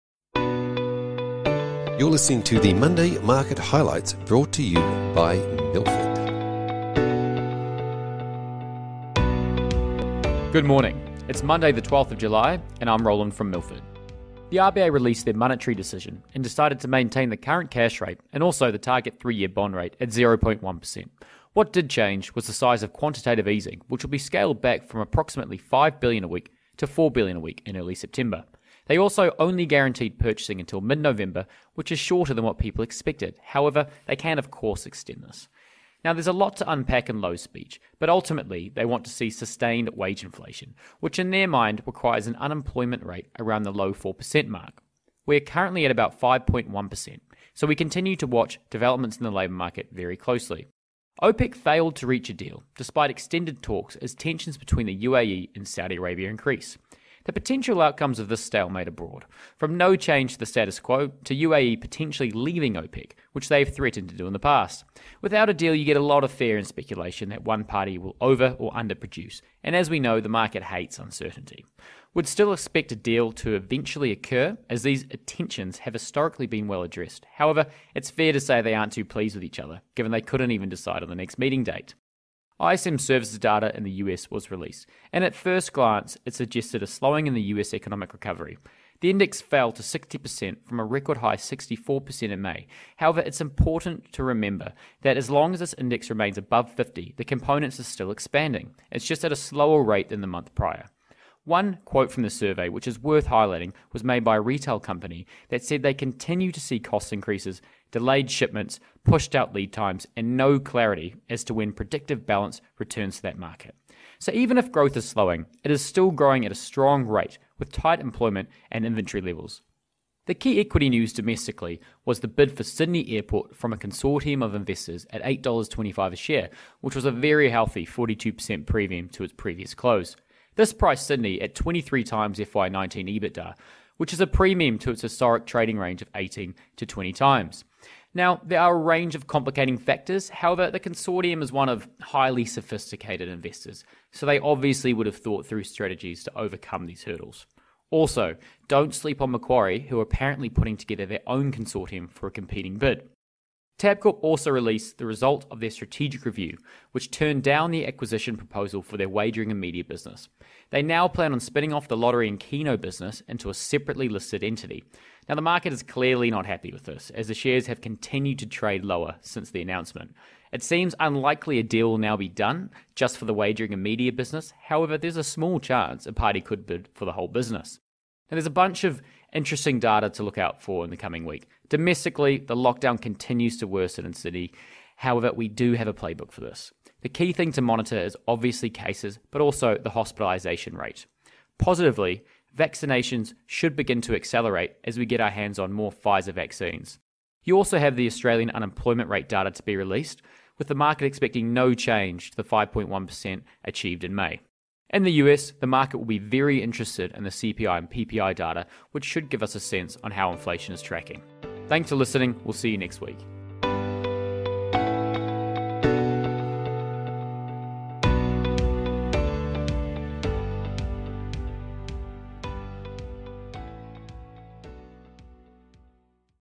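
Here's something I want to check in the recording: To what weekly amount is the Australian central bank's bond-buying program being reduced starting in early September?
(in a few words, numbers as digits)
4 billion a week.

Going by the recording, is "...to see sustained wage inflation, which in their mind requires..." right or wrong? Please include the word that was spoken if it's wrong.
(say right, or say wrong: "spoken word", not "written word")
right.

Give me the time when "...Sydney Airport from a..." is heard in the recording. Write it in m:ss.
2:02.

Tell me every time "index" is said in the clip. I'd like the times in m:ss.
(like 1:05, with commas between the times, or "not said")
1:29, 1:35.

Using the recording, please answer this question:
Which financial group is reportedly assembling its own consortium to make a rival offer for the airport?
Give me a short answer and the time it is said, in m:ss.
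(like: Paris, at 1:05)
Macquarie, at 2:29.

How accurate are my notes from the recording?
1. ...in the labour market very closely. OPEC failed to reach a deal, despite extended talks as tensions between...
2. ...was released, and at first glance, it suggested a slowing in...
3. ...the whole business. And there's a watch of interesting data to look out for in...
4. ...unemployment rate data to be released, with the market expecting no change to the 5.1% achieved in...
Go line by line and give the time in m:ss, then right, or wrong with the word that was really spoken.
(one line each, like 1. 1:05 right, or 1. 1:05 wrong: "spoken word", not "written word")
1. 0:49 right
2. 1:24 right
3. 2:57 wrong: "bunch", not "watch"
4. 3:18 right.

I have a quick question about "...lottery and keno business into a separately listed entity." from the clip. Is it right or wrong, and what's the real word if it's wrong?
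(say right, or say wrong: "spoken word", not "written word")
right.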